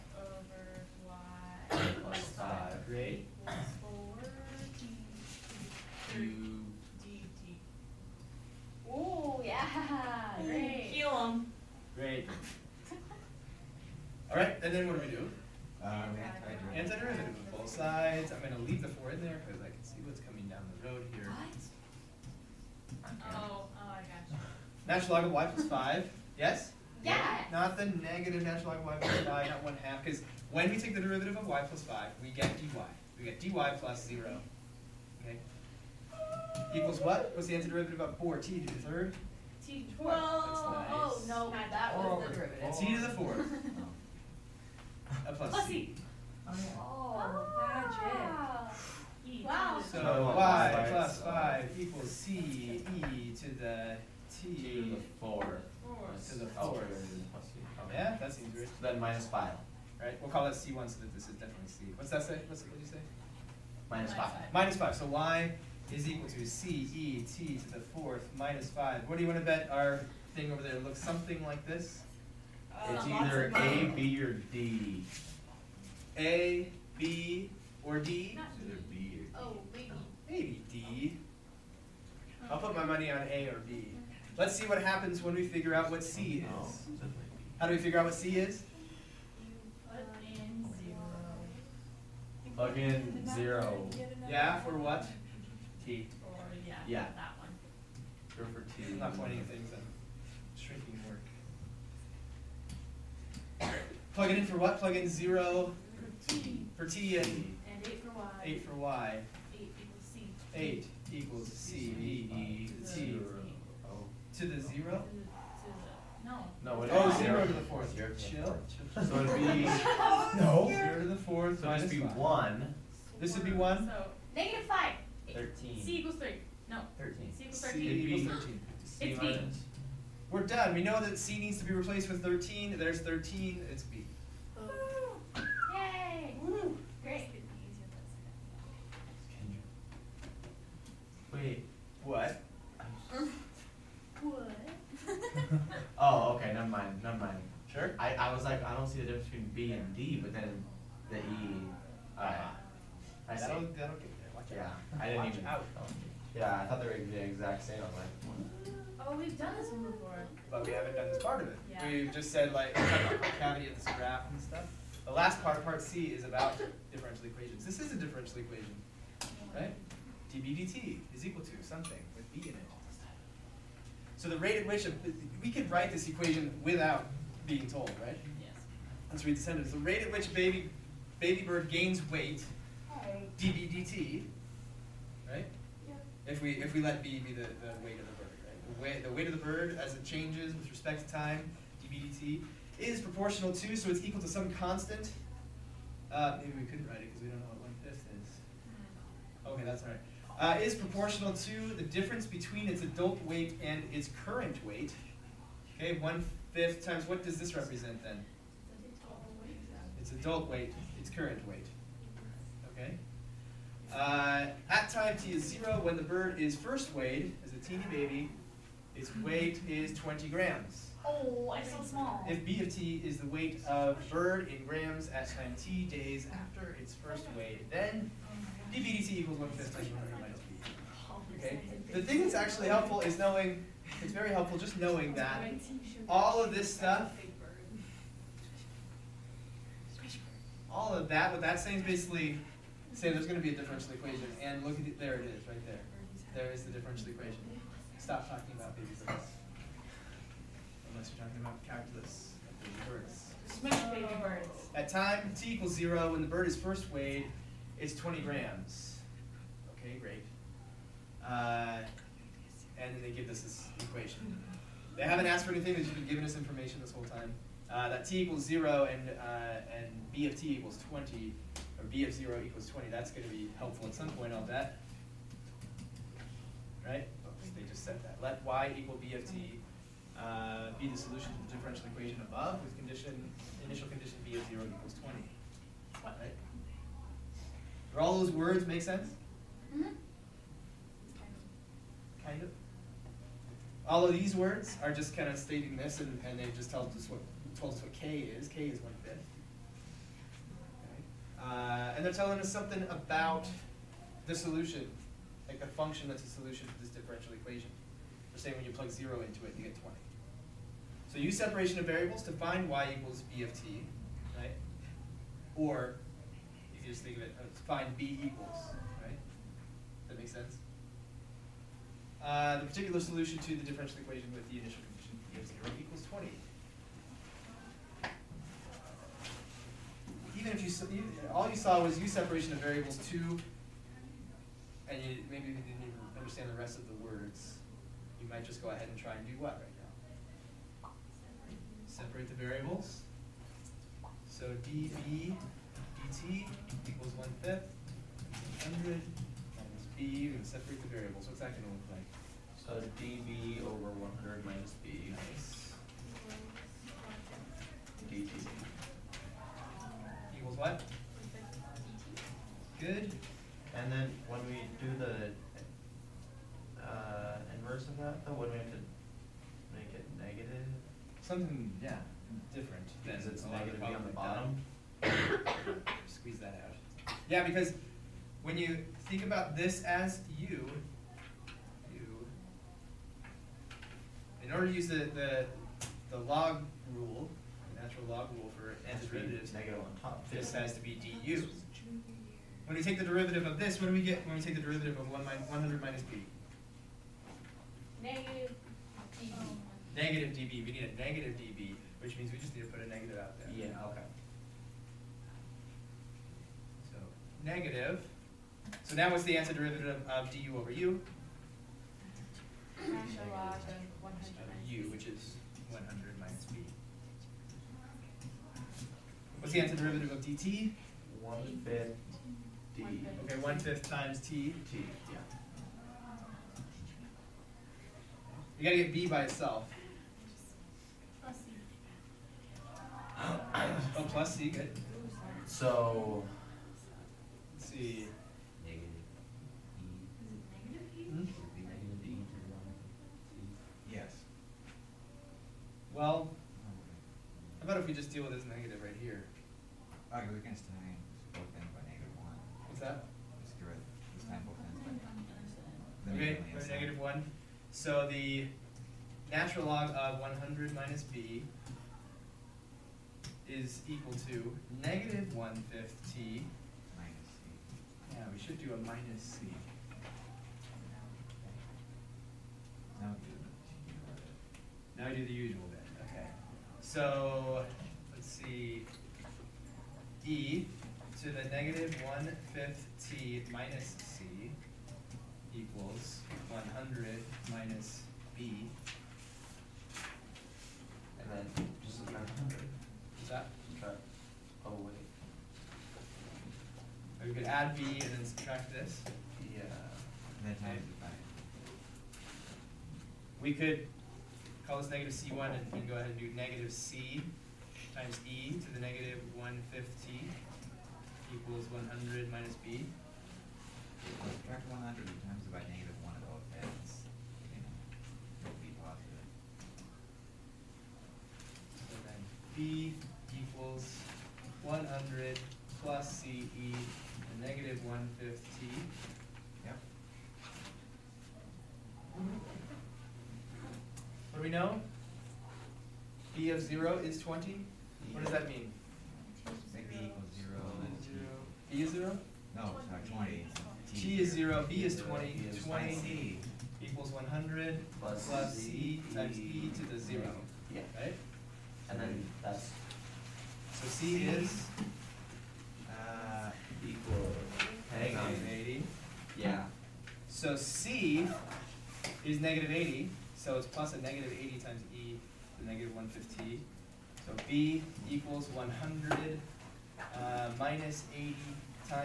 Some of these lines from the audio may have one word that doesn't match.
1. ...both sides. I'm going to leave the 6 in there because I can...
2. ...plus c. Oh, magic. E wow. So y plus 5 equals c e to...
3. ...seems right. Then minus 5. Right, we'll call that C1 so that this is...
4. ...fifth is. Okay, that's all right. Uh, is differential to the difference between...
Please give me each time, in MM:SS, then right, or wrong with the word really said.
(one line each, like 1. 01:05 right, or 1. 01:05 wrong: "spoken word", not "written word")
1. 00:17 wrong: "4", not "6"
2. 00:45 right
3. 00:58 right
4. 03:17 wrong: "proportional", not "differential".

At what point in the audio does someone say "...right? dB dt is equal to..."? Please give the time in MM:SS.
02:49.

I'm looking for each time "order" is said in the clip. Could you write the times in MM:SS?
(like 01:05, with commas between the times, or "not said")
06:24.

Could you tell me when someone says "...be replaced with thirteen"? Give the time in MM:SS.
02:11.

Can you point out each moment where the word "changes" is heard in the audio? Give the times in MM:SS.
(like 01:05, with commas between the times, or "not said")
03:10.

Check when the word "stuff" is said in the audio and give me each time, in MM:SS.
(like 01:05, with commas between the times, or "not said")
02:44, 03:56.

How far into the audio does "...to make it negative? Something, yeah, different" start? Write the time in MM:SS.
06:08.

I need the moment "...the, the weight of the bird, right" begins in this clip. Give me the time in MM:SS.
03:07.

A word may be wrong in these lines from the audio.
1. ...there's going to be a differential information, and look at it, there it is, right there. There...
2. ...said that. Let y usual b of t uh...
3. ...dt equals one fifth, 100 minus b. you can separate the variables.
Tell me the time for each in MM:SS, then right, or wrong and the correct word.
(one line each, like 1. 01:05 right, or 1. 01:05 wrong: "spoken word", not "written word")
1. 04:03 wrong: "equation", not "information"
2. 04:37 wrong: "equal", not "usual"
3. 05:46 right.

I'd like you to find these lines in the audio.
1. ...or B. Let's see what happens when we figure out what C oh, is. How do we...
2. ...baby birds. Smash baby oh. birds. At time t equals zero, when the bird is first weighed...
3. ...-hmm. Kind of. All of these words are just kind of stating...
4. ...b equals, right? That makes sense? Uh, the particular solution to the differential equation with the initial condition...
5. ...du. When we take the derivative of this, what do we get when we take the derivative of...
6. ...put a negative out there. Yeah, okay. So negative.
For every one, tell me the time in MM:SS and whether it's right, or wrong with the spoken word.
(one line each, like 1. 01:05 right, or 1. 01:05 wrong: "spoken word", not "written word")
1. 01:23 right
2. 04:12 right
3. 04:49 right
4. 05:17 right
5. 06:31 right
6. 06:42 right.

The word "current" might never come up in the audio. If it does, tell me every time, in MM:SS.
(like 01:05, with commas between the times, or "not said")
03:24, 03:31.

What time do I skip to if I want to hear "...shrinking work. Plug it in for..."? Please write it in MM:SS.
01:40.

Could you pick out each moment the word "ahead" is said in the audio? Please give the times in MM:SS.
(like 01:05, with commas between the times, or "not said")
05:38, 08:25.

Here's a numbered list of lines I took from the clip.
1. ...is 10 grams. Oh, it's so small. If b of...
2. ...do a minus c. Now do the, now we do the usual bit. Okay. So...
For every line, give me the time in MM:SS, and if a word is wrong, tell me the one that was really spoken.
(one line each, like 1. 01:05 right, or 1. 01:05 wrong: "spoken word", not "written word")
1. 03:39 wrong: "20", not "10"
2. 07:48 right.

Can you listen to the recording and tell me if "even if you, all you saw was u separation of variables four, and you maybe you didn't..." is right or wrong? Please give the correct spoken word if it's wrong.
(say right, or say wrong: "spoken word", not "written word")
wrong: "two", not "four".